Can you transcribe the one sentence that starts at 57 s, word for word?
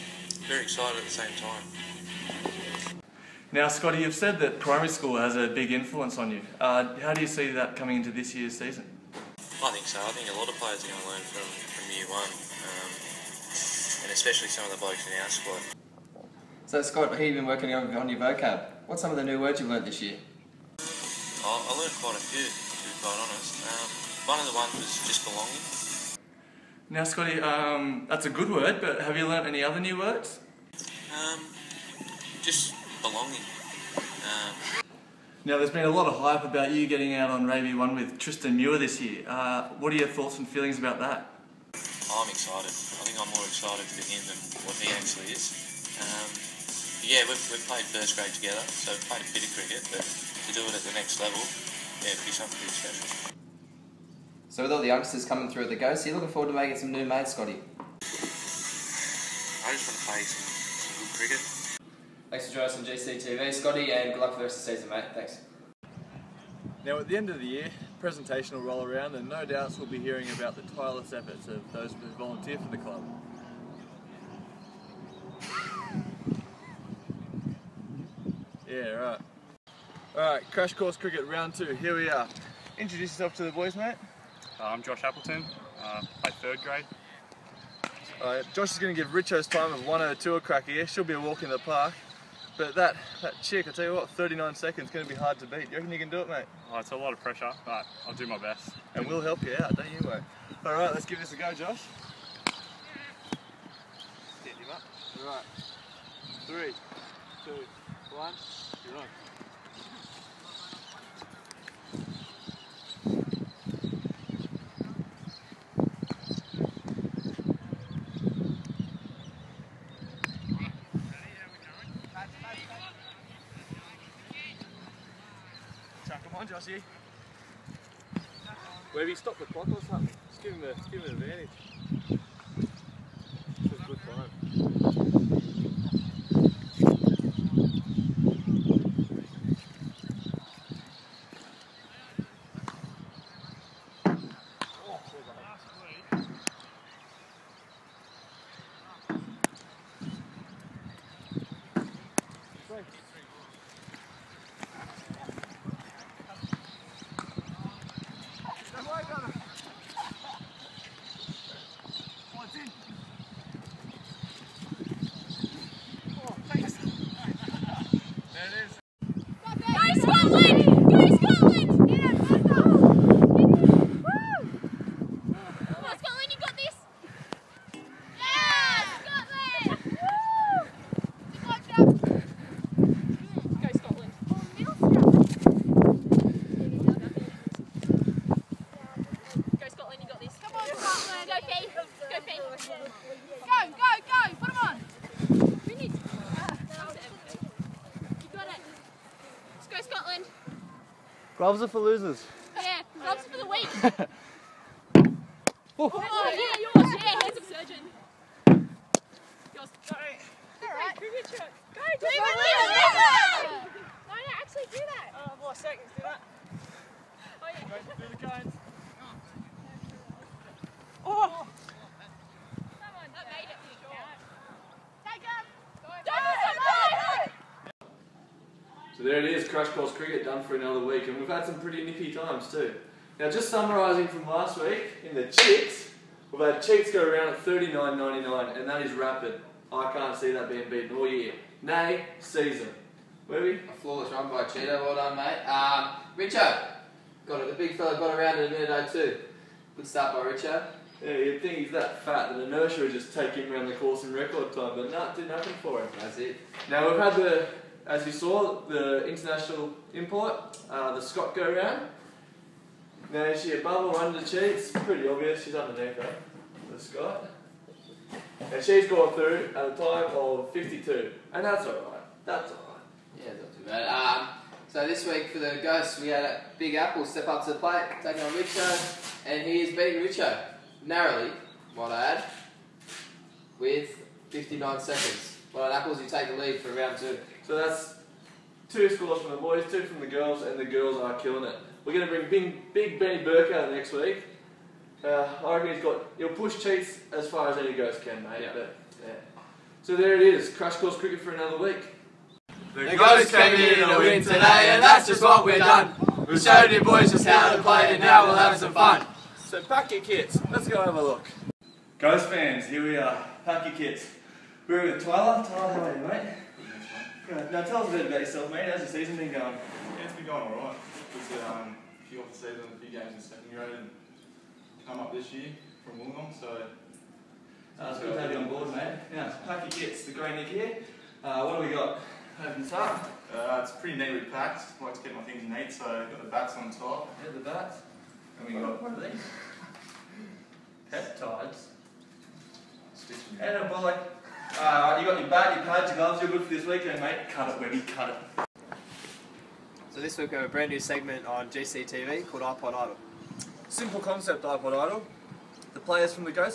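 I just want to play some, some good cricket.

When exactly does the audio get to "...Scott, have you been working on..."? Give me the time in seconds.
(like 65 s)
16 s.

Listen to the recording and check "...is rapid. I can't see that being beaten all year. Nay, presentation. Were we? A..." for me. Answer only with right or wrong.
wrong.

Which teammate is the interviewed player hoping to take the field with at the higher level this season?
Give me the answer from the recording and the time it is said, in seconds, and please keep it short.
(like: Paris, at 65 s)
Tristan Muir, at 38 s.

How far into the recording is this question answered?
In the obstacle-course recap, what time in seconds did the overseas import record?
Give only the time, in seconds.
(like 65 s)
270 s.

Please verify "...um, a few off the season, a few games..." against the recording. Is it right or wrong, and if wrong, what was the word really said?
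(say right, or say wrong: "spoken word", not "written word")
right.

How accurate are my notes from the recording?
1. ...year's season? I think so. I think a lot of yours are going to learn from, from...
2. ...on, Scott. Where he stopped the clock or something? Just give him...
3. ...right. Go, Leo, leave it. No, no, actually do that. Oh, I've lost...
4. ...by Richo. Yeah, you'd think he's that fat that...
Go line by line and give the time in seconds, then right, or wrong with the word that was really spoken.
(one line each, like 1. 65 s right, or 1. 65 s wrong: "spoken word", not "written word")
1. 8 s wrong: "players", not "yours"
2. 126 s wrong: "Jossie", not "Scott"
3. 210 s right
4. 250 s right.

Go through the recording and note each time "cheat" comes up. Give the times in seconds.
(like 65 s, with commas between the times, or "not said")
264 s, 296 s.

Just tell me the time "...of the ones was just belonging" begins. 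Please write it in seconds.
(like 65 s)
24 s.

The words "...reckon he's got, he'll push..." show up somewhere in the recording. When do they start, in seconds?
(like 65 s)
295 s.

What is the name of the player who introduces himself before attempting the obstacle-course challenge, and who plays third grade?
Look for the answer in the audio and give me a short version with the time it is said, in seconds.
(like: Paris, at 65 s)
Josh Appleton, at 84 s.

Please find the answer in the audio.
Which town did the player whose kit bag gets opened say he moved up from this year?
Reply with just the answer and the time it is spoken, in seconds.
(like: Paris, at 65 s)
Wollongong, at 325 s.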